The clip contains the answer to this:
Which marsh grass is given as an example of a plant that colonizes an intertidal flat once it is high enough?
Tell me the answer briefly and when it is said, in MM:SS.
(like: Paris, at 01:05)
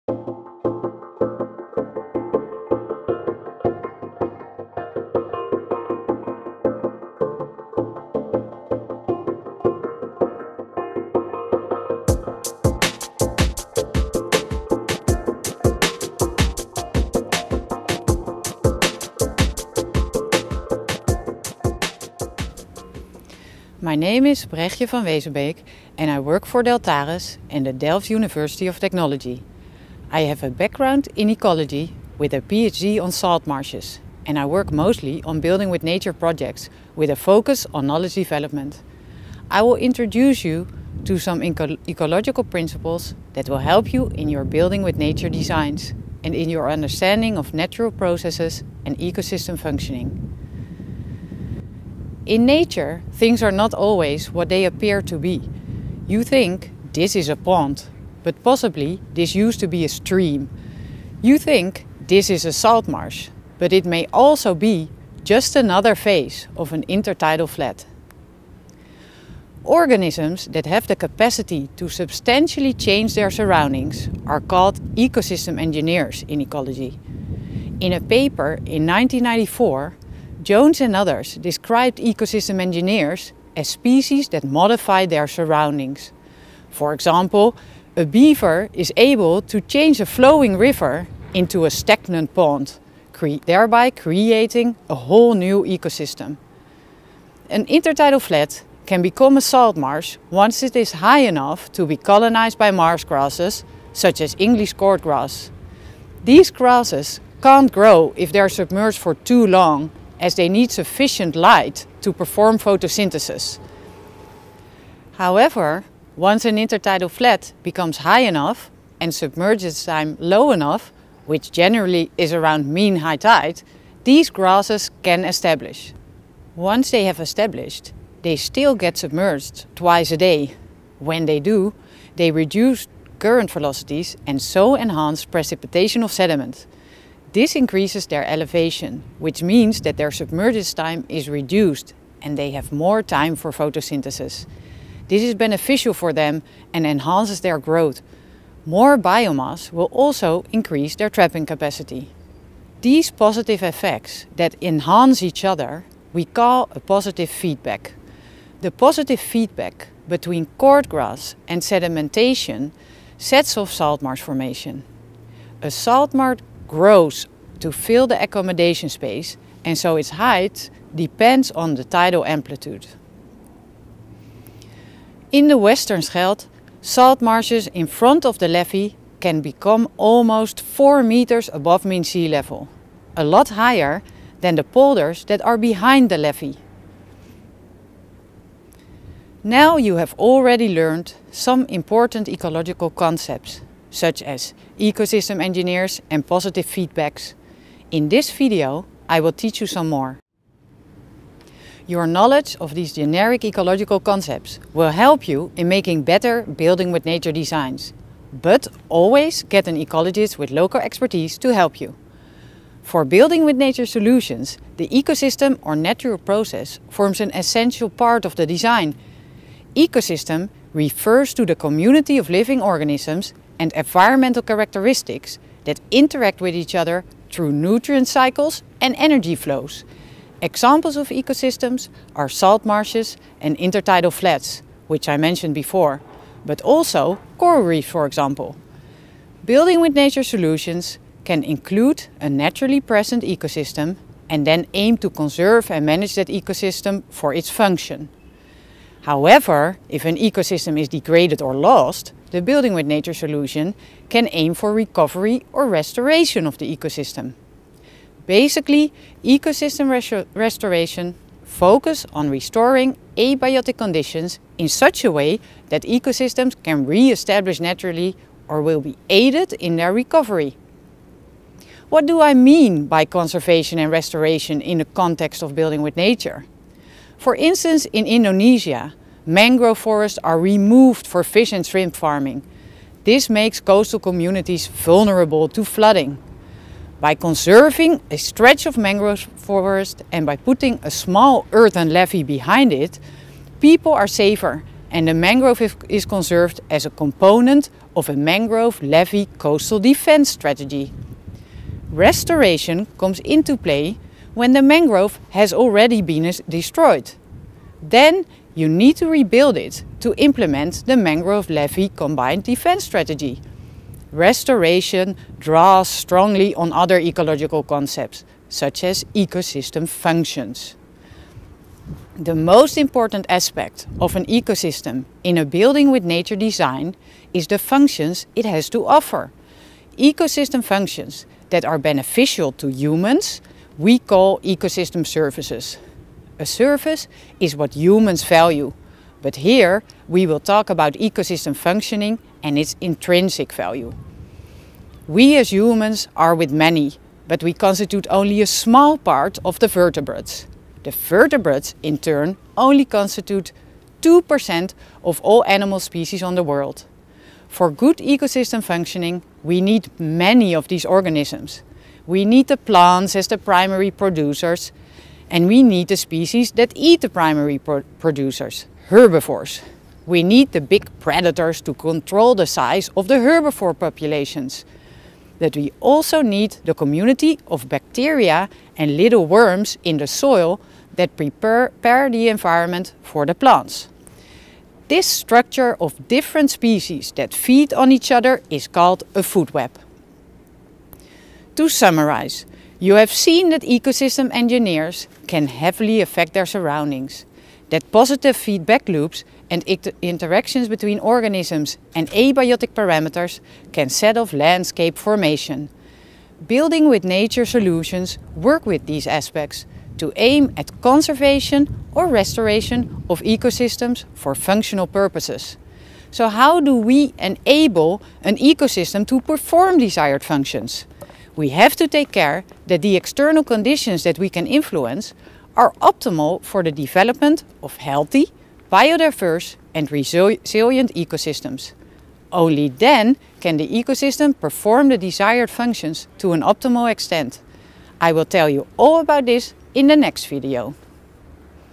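English cordgrass, at 01:44.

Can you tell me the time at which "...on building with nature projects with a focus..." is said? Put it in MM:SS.
00:35.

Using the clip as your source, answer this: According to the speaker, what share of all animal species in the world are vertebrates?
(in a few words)
2%.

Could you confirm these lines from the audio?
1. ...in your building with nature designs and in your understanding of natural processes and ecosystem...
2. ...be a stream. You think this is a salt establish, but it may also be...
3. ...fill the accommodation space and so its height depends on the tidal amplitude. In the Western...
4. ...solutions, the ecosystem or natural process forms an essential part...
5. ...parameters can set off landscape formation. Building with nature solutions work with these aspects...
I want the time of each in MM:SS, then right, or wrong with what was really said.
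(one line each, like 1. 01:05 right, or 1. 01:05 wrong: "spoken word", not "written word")
1. 00:44 right
2. 00:59 wrong: "marsh", not "establish"
3. 02:47 right
4. 03:33 right
5. 06:42 right.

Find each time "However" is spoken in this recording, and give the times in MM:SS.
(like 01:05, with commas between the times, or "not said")
01:55, 04:09.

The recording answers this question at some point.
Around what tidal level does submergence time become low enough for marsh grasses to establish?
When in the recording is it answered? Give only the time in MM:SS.
02:02.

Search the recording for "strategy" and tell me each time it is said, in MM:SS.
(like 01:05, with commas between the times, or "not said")
05:00, 05:12.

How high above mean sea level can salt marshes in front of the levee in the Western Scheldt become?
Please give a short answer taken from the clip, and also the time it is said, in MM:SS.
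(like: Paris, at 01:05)
almost 4 meters, at 02:59.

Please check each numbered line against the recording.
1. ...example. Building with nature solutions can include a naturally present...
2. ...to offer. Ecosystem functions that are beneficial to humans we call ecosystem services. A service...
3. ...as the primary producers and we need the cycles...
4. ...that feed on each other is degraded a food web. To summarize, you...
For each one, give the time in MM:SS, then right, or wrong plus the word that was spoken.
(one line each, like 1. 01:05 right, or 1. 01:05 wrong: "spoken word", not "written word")
1. 03:58 right
2. 05:28 right
3. 06:03 wrong: "species", not "cycles"
4. 06:27 wrong: "called", not "degraded".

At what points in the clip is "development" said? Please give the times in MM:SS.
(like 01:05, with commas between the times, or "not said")
00:38, 07:06.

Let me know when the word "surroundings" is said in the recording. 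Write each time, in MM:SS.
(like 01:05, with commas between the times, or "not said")
01:13, 01:25, 06:36.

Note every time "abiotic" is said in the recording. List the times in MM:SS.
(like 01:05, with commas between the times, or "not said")
04:23, 06:42.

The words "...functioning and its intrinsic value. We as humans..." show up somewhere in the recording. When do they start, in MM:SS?
05:41.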